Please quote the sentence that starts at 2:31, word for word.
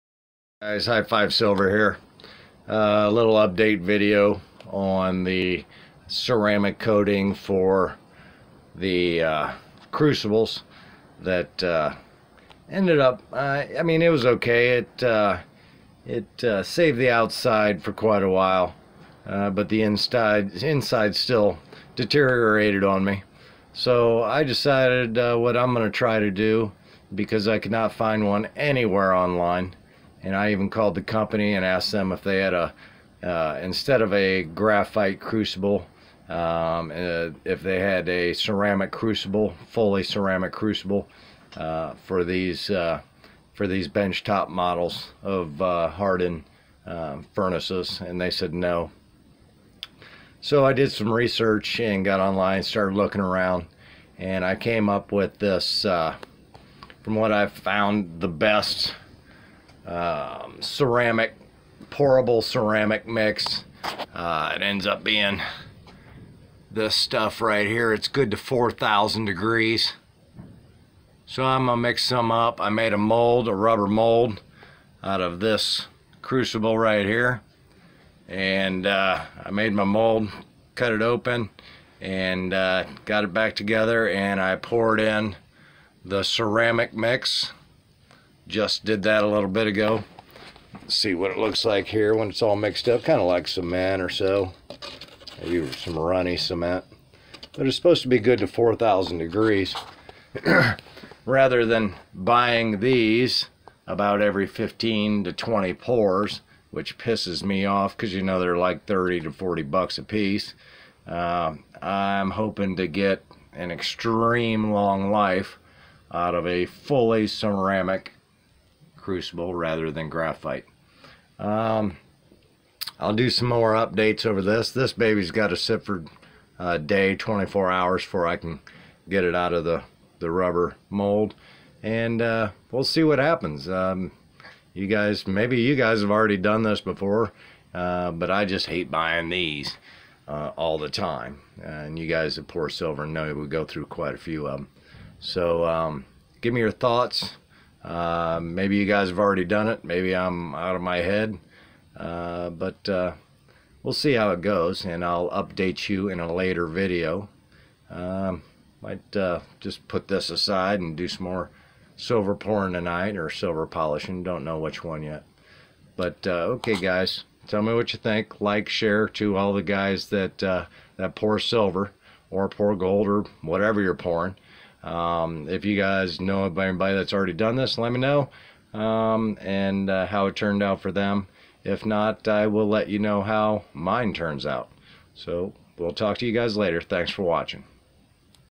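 Uh, but uh, we'll see how it goes, and I'll update you in a later video.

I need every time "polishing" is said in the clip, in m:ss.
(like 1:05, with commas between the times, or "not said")
2:43.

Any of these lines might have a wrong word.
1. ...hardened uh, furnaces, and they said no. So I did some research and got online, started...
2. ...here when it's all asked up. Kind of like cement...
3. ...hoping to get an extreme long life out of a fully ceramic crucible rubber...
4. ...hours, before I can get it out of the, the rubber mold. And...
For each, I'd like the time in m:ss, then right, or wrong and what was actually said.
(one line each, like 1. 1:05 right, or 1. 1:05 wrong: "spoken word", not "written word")
1. 0:45 right
2. 1:31 wrong: "mixed", not "asked"
3. 1:52 wrong: "rather", not "rubber"
4. 2:07 right.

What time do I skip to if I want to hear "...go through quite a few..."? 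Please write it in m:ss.
2:23.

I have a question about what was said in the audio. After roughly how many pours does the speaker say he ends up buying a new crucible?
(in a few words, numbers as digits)
15 to 20.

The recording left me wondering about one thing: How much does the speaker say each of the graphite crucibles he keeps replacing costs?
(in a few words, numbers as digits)
$30 to $40.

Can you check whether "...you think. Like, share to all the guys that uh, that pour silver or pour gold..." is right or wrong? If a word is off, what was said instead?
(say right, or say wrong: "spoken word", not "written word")
right.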